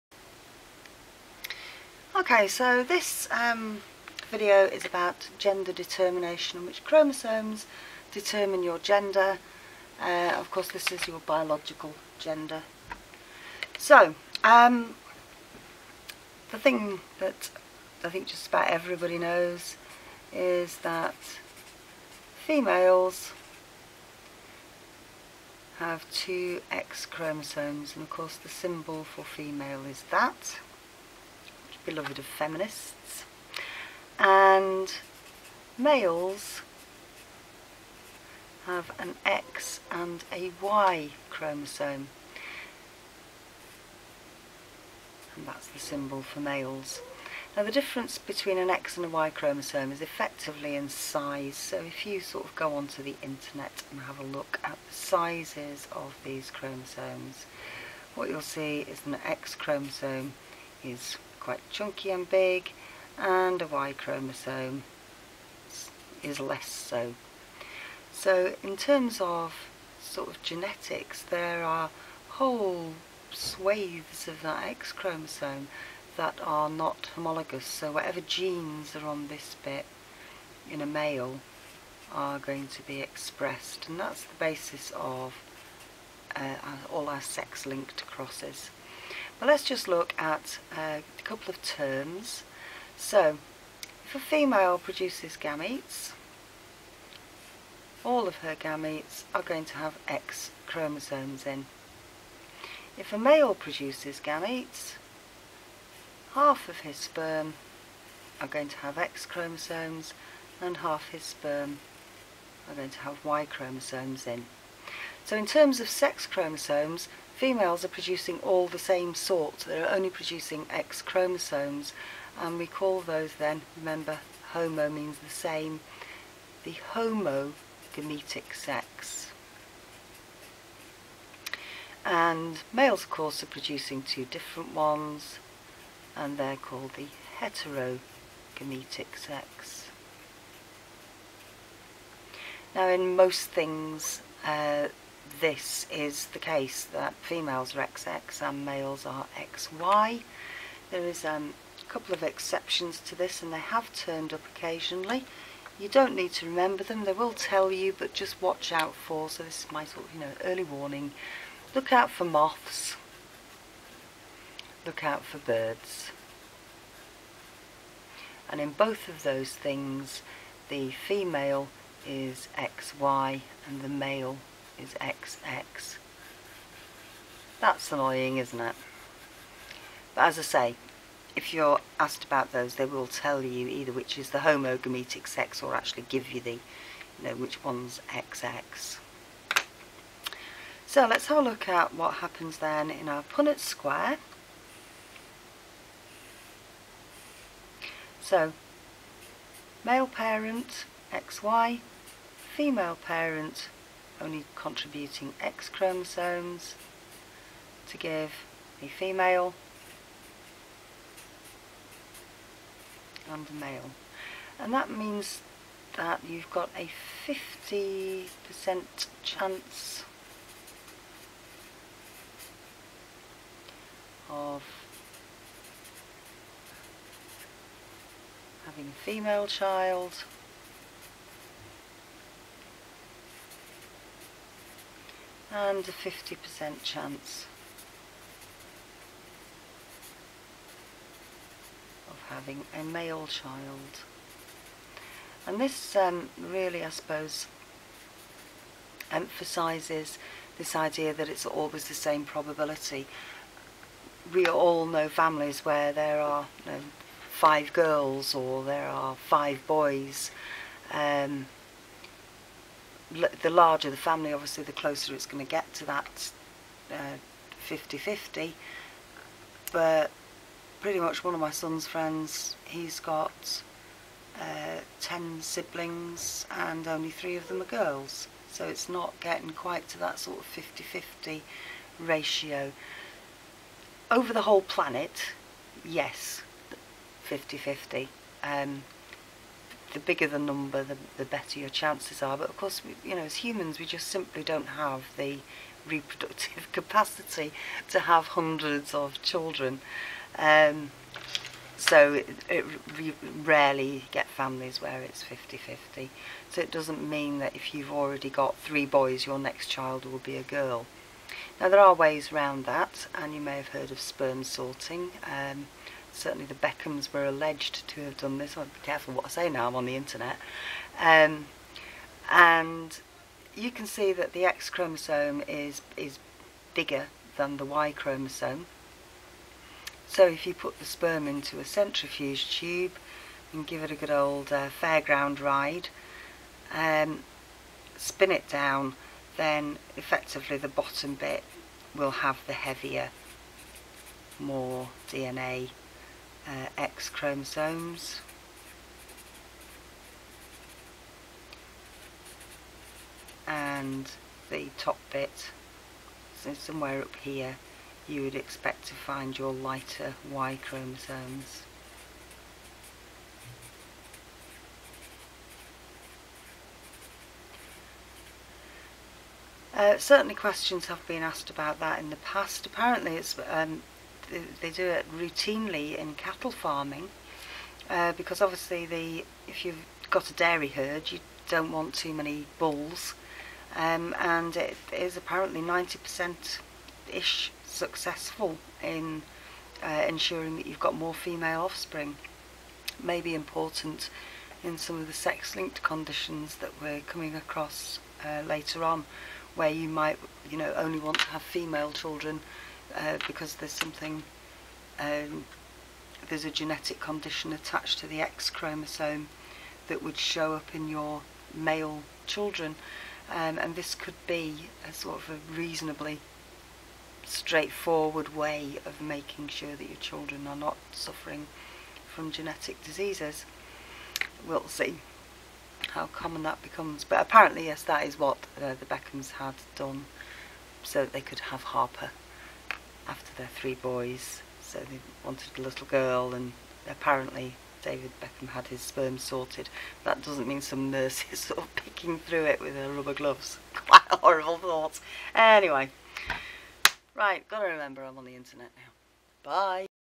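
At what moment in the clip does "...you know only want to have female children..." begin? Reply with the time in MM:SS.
06:40.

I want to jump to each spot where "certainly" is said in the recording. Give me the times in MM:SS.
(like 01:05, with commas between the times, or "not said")
05:16, 06:09.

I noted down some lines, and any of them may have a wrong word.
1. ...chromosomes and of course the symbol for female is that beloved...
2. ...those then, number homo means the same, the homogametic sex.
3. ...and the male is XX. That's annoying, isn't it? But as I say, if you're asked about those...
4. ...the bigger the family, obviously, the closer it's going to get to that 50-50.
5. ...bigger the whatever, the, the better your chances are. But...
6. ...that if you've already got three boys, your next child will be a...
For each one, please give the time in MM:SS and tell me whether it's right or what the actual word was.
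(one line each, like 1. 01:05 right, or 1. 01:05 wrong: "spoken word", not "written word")
1. 00:27 right
2. 02:03 wrong: "remember", not "number"
3. 02:53 right
4. 04:23 wrong: "larger", not "bigger"
5. 04:49 wrong: "number", not "whatever"
6. 05:07 right.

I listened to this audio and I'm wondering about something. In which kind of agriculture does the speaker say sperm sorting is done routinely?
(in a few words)
cattle farming.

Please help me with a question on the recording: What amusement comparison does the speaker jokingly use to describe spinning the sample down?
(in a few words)
fairground ride.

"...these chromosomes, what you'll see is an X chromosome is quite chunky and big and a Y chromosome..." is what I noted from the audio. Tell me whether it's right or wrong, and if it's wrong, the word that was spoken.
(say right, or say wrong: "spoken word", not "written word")
right.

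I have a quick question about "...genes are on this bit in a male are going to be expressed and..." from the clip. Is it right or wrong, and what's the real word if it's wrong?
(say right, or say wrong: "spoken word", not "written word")
right.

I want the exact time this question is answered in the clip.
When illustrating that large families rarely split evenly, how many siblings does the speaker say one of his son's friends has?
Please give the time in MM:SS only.
04:35.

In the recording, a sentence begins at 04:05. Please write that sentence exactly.
And this um, really, I suppose, emphasises this idea that it's always the same probability.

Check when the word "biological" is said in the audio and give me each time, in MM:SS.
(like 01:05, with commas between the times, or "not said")
00:11.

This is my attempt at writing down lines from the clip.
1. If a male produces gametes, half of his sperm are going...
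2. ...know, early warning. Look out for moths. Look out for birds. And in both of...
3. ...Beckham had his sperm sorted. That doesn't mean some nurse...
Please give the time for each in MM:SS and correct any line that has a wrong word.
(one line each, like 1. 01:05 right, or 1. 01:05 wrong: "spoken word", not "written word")
1. 01:42 right
2. 02:40 right
3. 07:18 right.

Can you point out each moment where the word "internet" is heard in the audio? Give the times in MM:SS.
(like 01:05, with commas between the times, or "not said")
00:53, 05:19, 07:28.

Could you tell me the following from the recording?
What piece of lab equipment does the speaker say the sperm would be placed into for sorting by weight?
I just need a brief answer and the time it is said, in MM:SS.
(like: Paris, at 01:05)
centrifuge tube, at 05:31.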